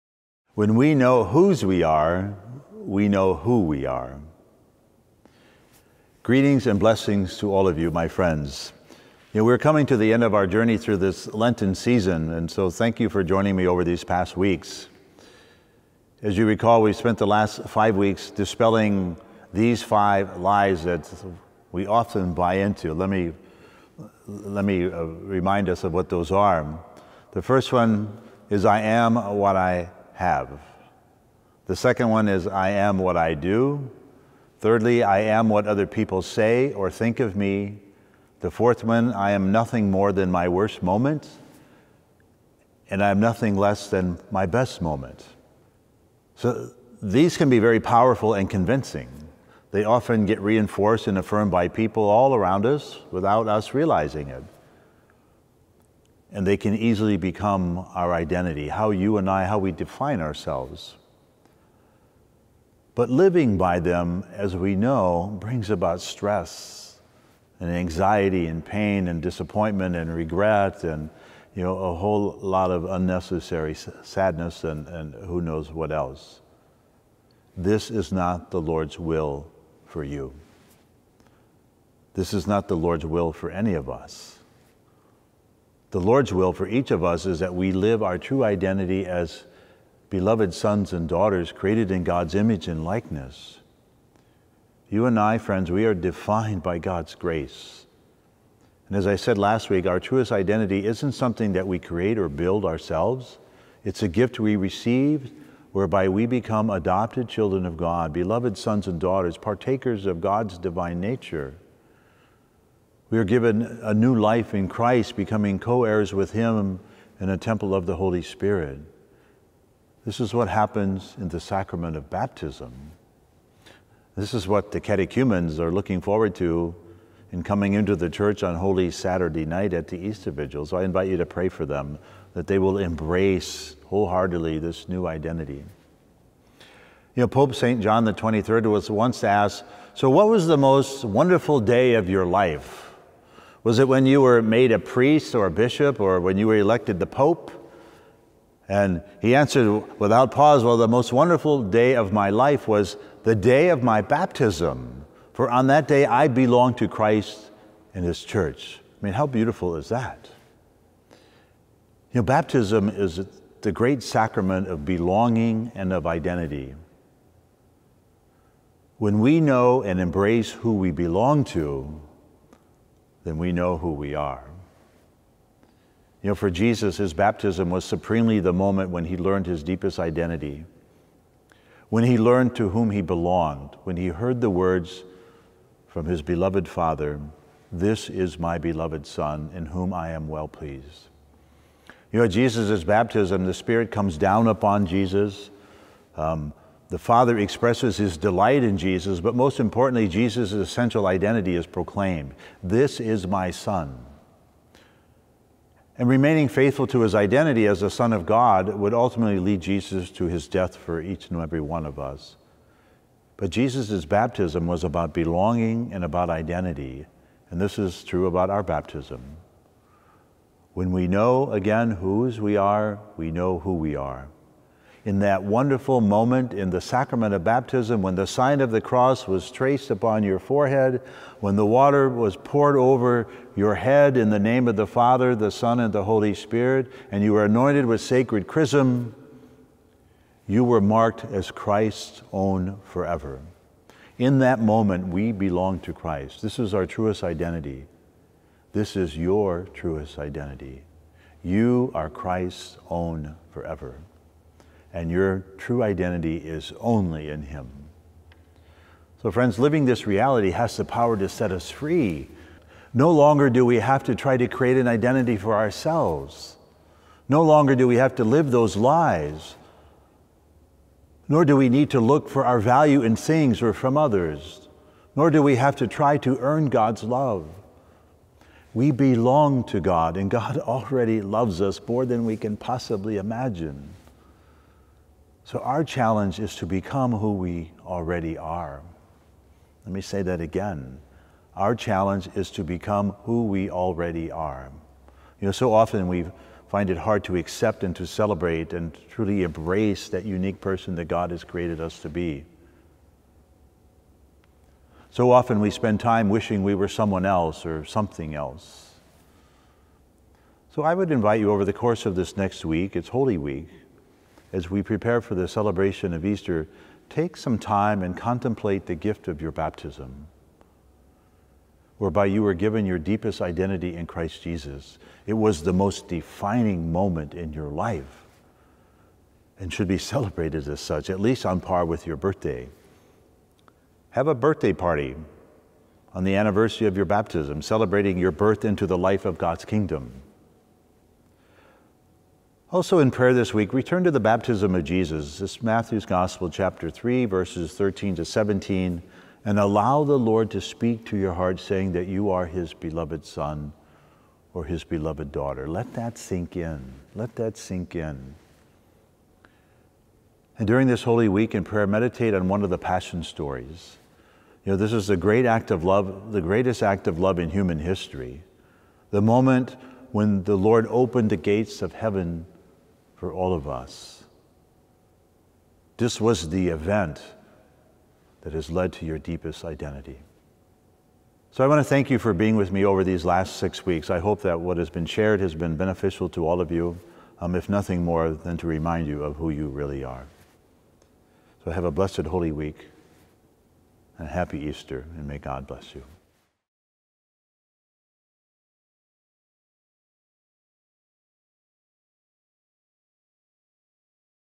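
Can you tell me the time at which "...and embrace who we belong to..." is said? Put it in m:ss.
2:49.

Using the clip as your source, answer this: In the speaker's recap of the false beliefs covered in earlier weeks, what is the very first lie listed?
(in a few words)
I am what I have.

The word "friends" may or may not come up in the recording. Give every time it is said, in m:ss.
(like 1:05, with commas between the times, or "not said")
0:08, 1:35, 4:19.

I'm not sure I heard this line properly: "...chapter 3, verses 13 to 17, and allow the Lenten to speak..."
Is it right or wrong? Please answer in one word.
wrong.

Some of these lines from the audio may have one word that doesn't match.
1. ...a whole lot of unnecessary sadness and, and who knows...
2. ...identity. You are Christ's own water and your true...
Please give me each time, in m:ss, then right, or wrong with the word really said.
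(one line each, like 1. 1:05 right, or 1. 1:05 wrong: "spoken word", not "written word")
1. 1:11 right
2. 4:10 wrong: "forever", not "water".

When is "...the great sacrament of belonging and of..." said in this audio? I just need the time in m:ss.
2:43.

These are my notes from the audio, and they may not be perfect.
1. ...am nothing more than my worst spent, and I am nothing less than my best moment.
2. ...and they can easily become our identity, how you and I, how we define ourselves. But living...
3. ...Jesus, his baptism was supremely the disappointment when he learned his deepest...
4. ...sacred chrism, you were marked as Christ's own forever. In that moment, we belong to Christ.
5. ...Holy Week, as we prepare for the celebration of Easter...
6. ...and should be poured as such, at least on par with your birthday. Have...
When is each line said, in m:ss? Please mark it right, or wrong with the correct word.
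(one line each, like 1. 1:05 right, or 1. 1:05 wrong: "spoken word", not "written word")
1. 0:39 wrong: "moment", not "spent"
2. 0:56 right
3. 2:56 wrong: "moment", not "disappointment"
4. 3:57 right
5. 5:13 right
6. 5:29 wrong: "celebrated", not "poured".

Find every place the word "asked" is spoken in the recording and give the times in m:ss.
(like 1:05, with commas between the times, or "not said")
2:19.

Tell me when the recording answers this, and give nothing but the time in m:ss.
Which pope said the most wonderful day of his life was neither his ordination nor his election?
2:17.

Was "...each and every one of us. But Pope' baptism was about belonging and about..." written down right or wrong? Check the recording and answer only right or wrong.
wrong.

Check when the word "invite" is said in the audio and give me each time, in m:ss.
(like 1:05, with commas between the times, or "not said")
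2:10, 5:11.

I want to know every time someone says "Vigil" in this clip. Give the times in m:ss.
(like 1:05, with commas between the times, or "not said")
2:10.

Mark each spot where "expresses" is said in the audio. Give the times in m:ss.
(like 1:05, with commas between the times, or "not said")
3:17.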